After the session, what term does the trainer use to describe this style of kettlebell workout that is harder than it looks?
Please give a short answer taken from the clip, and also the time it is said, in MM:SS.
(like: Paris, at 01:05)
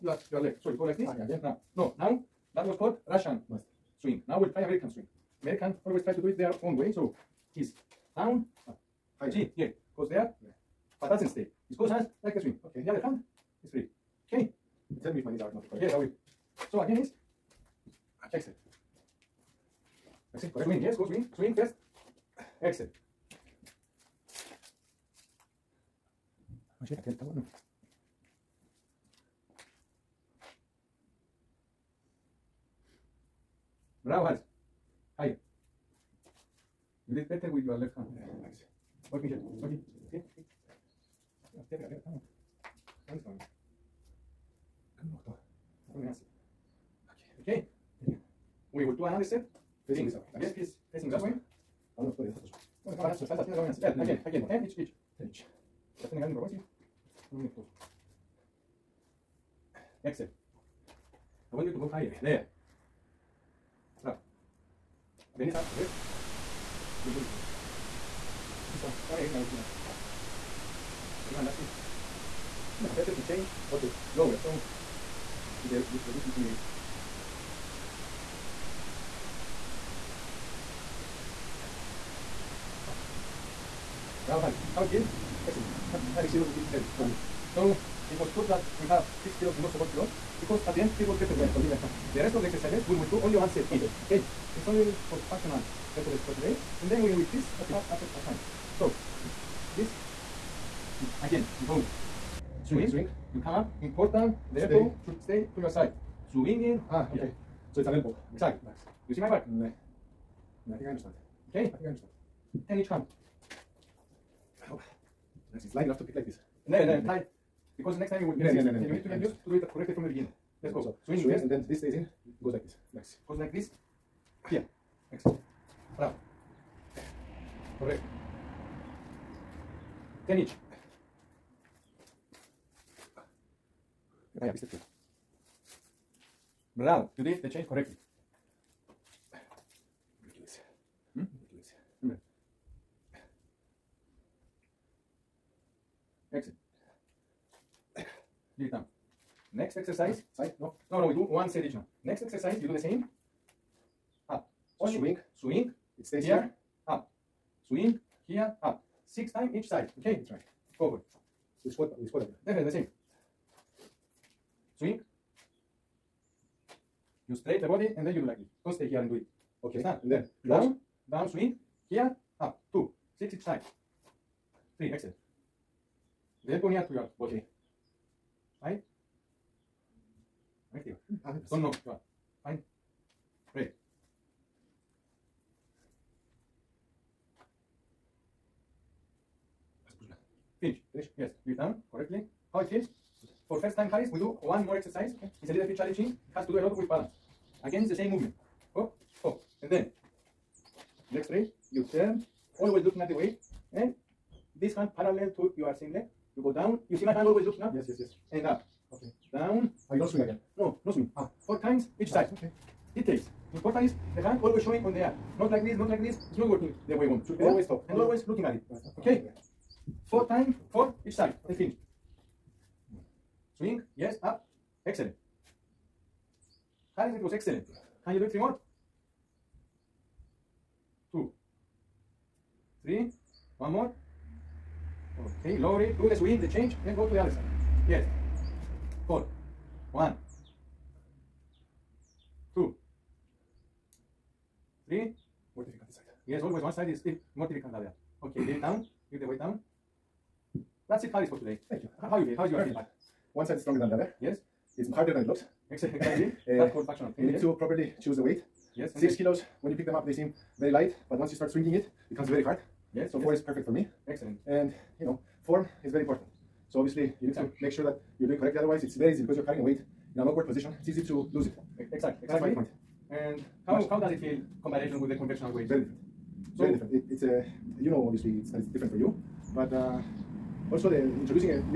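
functional training, at 04:16.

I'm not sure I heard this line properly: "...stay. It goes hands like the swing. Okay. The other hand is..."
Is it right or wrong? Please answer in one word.
right.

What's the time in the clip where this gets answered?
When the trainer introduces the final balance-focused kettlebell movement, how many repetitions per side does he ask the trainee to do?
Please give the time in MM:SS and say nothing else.
03:31.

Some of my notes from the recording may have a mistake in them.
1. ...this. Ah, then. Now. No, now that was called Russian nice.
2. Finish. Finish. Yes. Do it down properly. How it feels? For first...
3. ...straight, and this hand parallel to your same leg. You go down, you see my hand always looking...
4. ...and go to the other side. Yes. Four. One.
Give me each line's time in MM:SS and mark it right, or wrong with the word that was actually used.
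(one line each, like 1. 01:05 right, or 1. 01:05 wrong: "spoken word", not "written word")
1. 00:00 right
2. 03:10 wrong: "correctly", not "properly"
3. 03:23 wrong: "weight", not "straight"
4. 03:56 right.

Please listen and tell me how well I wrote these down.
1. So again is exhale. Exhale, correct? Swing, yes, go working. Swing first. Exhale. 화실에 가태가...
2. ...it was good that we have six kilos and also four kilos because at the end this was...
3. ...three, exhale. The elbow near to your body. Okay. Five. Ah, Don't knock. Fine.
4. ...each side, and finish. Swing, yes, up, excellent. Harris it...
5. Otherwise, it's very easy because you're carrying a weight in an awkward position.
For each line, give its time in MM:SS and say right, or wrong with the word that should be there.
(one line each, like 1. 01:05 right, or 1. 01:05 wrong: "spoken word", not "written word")
1. 00:16 wrong: "swing", not "working"
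2. 01:28 right
3. 02:54 right
4. 03:41 right
5. 04:28 right.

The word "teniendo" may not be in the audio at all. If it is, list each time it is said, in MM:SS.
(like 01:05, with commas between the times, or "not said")
00:56.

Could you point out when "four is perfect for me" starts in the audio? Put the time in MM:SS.
04:23.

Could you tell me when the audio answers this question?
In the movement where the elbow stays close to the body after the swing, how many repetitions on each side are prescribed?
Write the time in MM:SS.
02:39.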